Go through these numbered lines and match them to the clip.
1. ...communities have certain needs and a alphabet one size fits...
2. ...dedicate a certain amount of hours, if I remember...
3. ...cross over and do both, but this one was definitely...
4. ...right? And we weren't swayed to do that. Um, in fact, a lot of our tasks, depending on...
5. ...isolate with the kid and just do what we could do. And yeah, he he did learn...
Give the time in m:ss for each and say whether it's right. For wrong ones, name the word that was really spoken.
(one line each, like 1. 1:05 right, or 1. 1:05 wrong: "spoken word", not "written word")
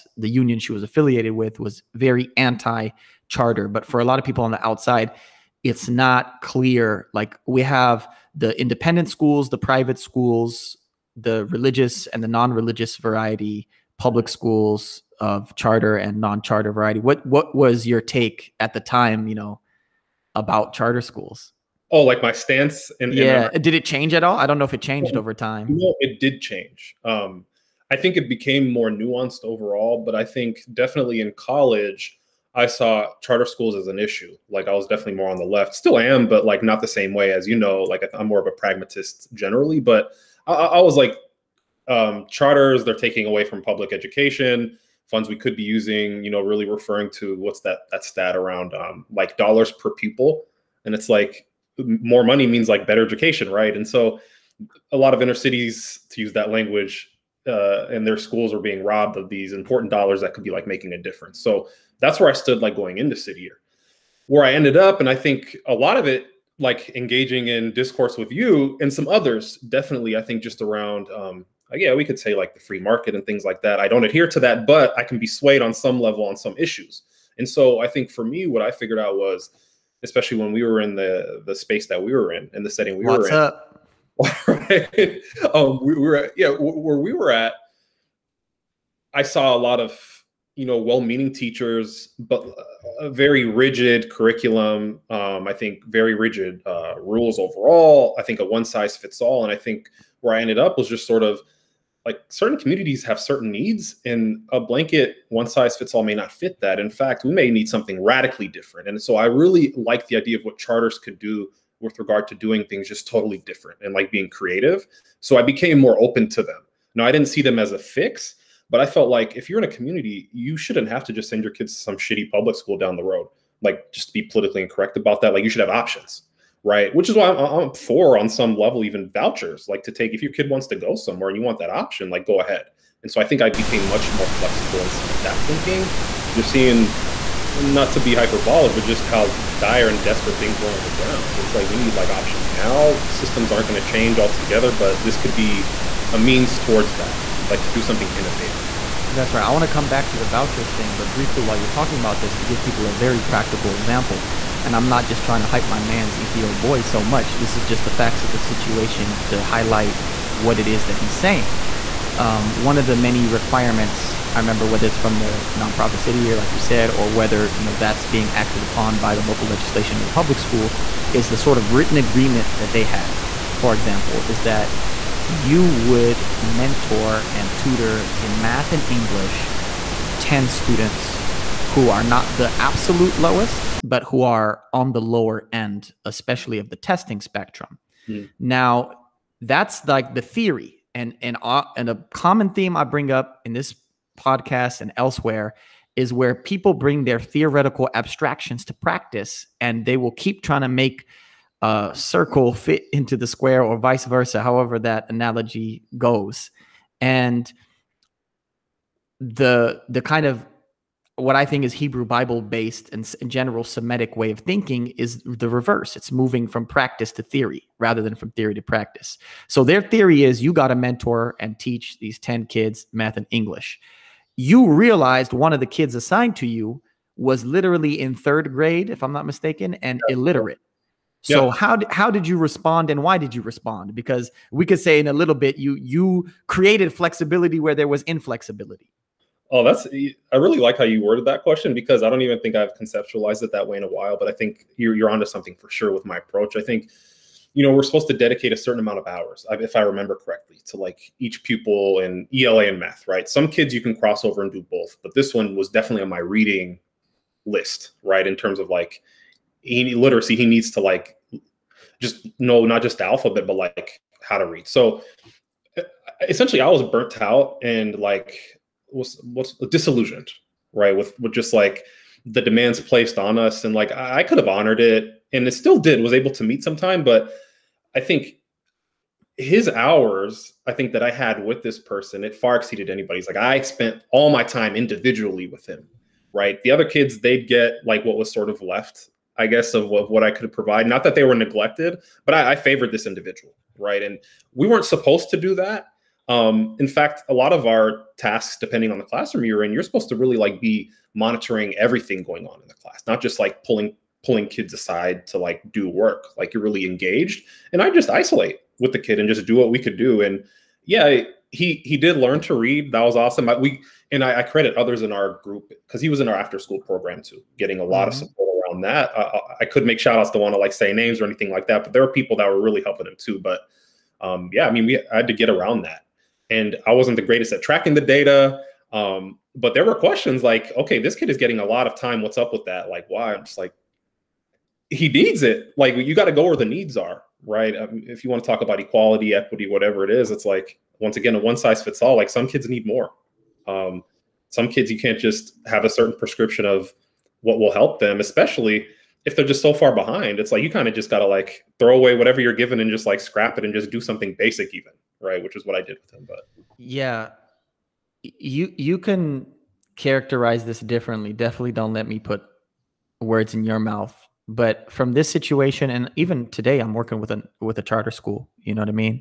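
1. 1:42 wrong: "blanket", not "alphabet"
2. 4:08 right
3. 4:13 right
4. 4:53 wrong: "supposed", not "swayed"
5. 5:08 right.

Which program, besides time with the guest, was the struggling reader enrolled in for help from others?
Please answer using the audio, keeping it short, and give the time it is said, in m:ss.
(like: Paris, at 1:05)
After school program, at 5:16.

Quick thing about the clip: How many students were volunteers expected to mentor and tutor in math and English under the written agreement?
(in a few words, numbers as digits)
10.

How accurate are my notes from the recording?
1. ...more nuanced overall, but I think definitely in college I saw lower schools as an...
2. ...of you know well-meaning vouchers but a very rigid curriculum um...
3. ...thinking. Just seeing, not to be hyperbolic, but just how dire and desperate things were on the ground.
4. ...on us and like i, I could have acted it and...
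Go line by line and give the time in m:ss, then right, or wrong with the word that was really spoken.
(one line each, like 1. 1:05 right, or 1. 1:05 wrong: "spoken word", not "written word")
1. 0:28 wrong: "charter", not "lower"
2. 1:29 wrong: "teachers", not "vouchers"
3. 2:15 right
4. 4:33 wrong: "honored", not "acted".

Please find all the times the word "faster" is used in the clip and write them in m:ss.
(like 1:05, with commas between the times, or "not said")
not said.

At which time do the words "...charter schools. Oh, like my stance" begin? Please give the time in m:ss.
0:20.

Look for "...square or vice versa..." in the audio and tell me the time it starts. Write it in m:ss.
3:23.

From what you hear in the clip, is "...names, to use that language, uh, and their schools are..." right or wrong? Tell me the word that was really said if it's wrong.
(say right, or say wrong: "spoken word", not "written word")
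wrong: "cities", not "names".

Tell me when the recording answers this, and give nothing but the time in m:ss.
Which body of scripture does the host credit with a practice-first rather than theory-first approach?
3:31.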